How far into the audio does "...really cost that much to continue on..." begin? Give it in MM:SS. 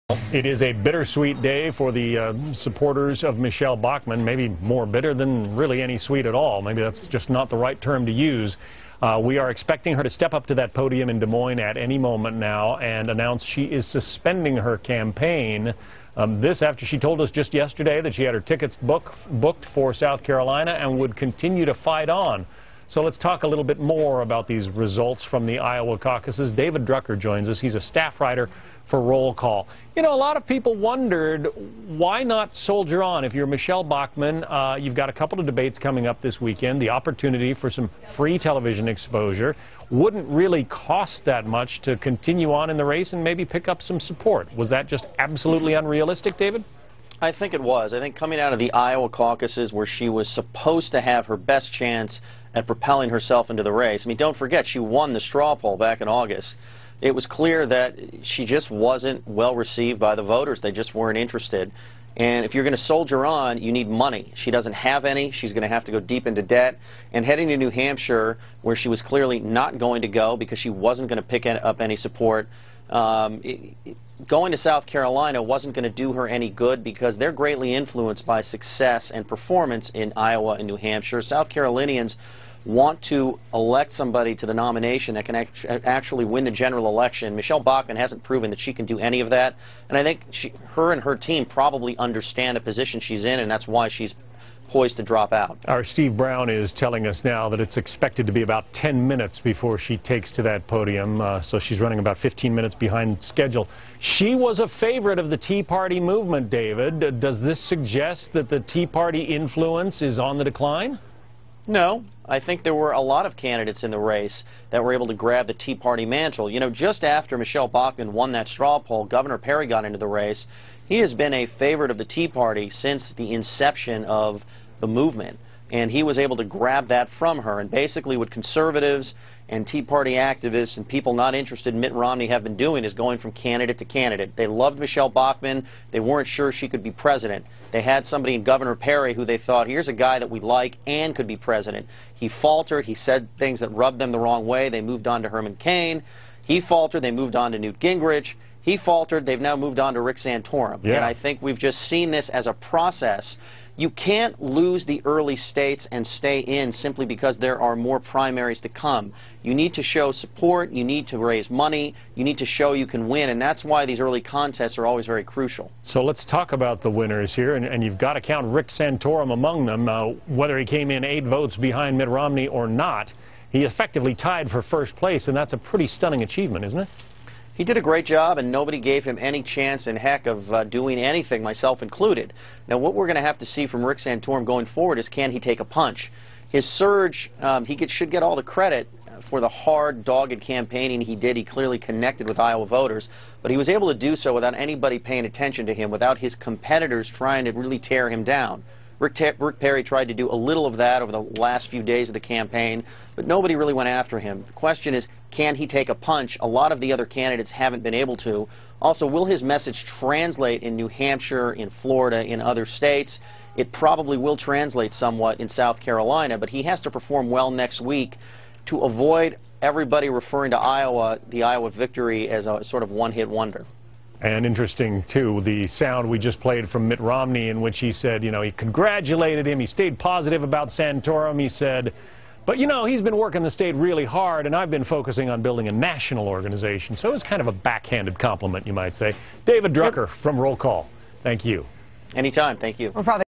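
00:40.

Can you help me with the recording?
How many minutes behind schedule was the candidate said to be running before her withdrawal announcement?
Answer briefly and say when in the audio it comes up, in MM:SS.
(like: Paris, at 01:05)
15, at 01:42.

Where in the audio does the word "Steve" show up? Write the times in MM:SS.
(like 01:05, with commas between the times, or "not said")
01:35.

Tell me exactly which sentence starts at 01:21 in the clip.
South Carolinians want to elect somebody to the nomination that can act actually win the general election.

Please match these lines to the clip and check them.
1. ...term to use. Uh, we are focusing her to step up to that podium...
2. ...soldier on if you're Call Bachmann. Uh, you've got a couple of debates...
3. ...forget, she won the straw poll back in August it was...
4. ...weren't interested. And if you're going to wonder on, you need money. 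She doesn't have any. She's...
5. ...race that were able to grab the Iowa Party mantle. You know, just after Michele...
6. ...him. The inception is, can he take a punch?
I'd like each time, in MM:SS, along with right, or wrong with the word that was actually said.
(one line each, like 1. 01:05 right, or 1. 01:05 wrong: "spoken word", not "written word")
1. 00:07 wrong: "expecting", not "focusing"
2. 00:32 wrong: "Michele", not "Call"
3. 00:54 right
4. 01:00 wrong: "soldier", not "wonder"
5. 01:53 wrong: "Tea", not "Iowa"
6. 03:24 wrong: "question", not "inception".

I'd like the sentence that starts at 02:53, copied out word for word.
He effectively tied for first place, and that's a pretty stunning achievement, isn't it?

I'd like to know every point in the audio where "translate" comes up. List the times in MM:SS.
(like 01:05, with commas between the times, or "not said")
03:29, 03:34.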